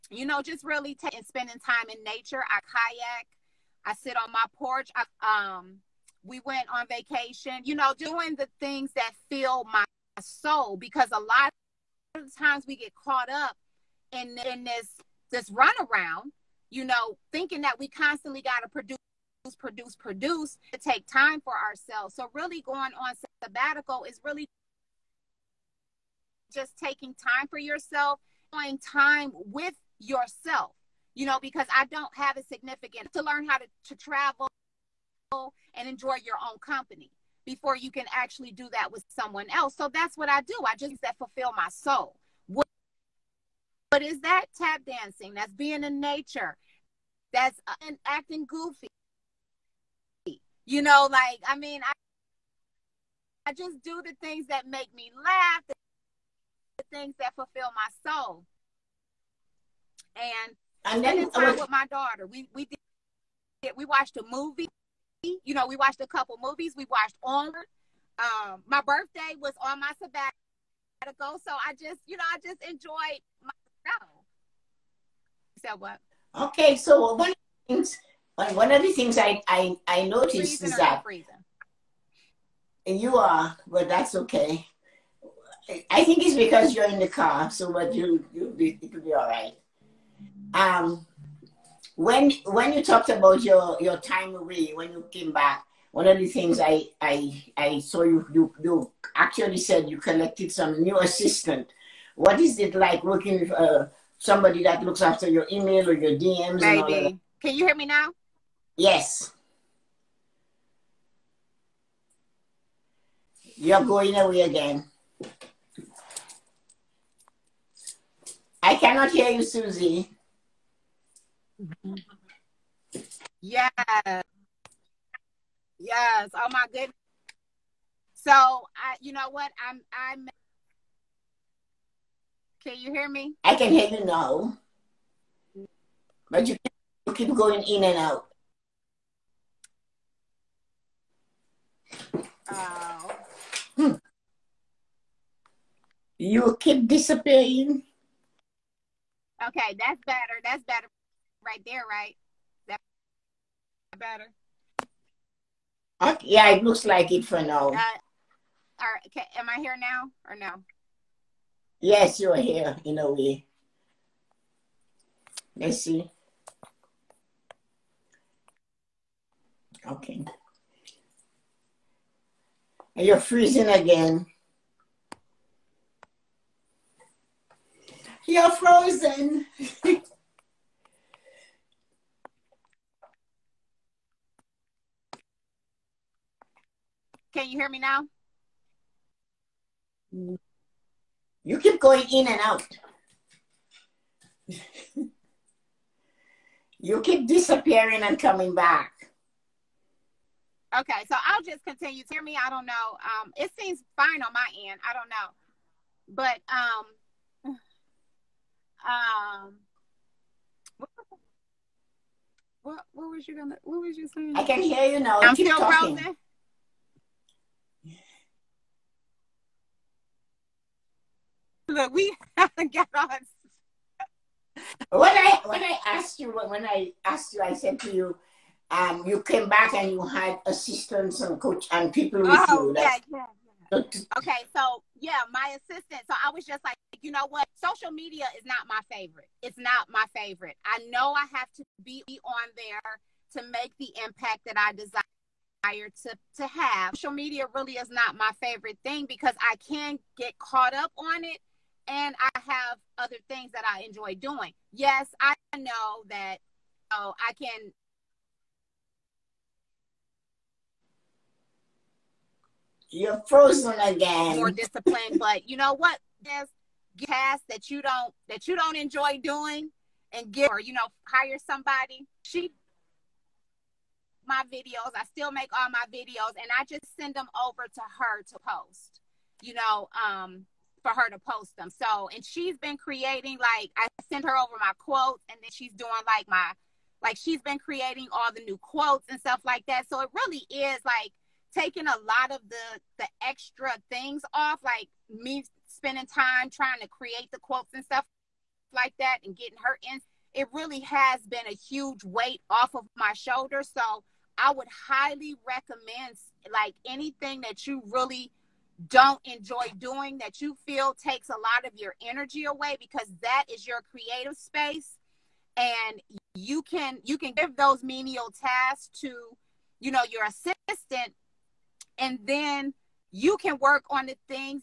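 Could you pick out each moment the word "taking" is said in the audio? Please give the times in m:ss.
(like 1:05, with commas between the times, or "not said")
0:00, 0:26, 4:51.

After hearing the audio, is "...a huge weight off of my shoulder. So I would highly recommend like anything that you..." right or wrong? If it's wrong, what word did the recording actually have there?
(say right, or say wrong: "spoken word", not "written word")
right.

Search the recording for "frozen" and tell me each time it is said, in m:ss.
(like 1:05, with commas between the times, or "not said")
2:58, 3:35, 4:23.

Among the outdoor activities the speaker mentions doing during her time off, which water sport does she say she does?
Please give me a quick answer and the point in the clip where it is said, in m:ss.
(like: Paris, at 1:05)
kayak, at 0:02.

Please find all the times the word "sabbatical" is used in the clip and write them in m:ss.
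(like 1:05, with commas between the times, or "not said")
0:23, 1:10.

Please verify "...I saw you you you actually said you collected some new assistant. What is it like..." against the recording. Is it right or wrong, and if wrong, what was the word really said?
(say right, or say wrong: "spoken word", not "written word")
right.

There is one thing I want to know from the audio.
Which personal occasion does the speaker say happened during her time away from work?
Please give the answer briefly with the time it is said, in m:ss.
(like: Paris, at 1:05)
My birthday, at 1:08.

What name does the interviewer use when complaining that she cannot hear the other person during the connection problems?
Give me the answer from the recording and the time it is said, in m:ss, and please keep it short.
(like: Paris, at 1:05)
Suzie, at 1:59.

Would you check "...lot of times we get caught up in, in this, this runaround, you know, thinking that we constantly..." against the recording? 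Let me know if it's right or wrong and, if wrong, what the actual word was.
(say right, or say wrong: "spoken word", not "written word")
right.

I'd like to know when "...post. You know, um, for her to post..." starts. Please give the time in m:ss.
4:38.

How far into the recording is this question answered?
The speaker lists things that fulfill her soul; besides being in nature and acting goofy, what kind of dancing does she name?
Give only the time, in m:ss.
0:44.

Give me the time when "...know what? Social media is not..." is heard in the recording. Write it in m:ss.
3:57.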